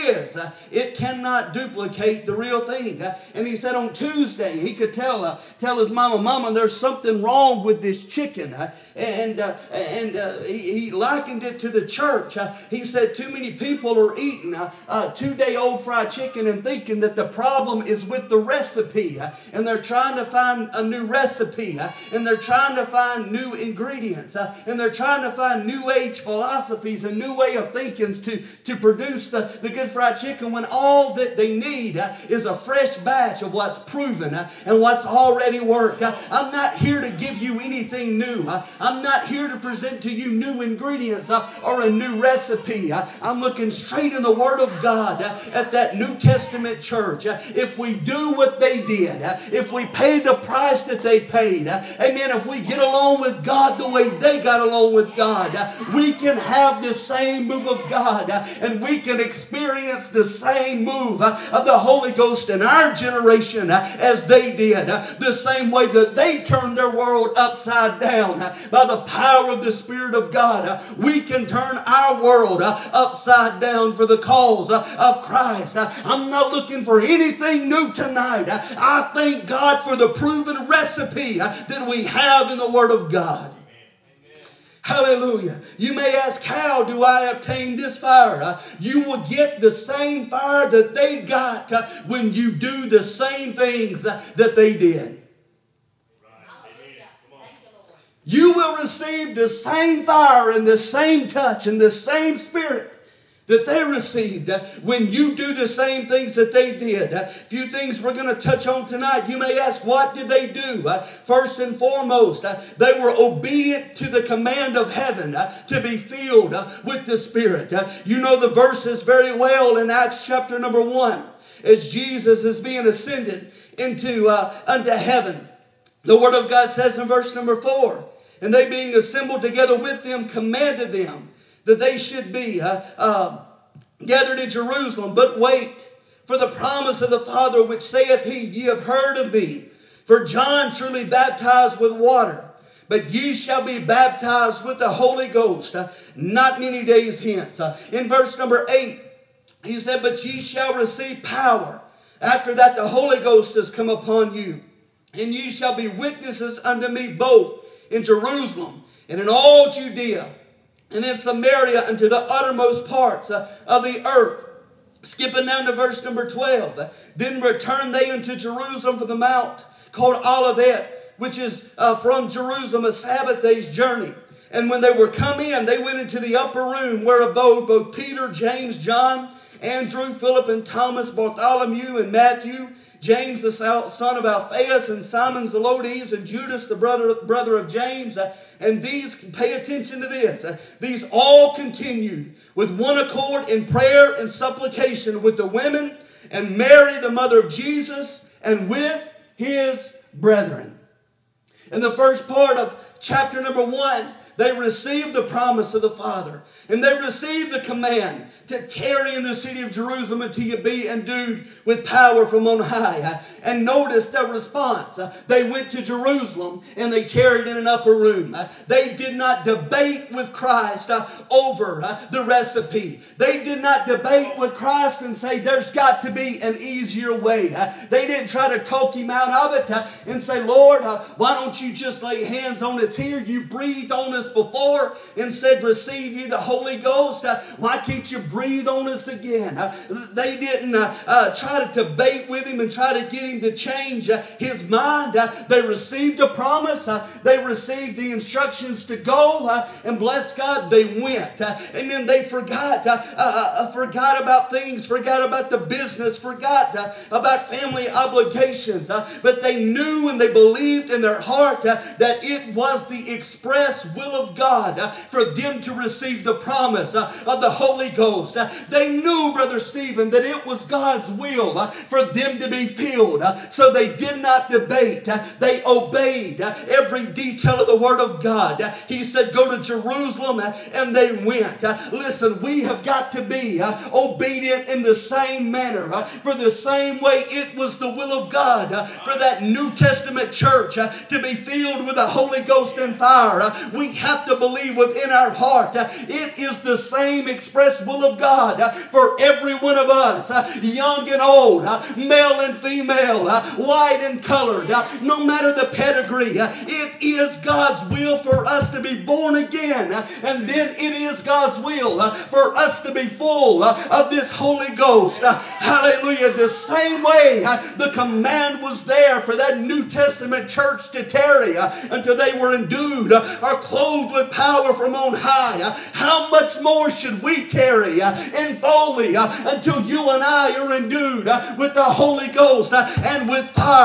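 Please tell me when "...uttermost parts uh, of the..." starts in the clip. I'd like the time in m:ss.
2:42.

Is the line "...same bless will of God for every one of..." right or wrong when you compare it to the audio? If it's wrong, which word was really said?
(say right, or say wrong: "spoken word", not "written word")
wrong: "express", not "bless".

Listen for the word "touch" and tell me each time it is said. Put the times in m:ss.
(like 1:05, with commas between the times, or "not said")
1:41, 1:48.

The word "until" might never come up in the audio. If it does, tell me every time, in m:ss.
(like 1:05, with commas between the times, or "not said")
3:30, 5:21, 5:29.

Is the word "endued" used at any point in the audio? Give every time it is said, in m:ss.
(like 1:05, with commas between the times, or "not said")
3:30, 5:22, 5:30.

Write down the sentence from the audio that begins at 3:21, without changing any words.
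In the first part of chapter number one, they received the promise of the Father.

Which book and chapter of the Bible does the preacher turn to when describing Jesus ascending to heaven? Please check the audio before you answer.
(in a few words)
Acts chapter 1.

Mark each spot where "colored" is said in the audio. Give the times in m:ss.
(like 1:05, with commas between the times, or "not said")
5:04.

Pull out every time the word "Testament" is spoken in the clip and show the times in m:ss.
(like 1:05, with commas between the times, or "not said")
0:46, 4:49, 5:19.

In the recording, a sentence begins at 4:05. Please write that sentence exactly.
They received a promise, they received the instructions to go, and bless God, they went.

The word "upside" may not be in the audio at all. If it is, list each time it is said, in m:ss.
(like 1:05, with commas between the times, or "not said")
1:07, 1:12.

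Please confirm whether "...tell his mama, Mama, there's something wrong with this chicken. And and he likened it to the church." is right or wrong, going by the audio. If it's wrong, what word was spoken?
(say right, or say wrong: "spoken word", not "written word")
right.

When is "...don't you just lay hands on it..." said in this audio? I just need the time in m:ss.
3:51.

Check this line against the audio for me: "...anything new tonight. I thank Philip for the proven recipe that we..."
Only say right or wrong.
wrong.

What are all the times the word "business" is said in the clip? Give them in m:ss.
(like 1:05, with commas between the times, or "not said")
4:15.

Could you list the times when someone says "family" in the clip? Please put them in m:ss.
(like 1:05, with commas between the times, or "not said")
4:17.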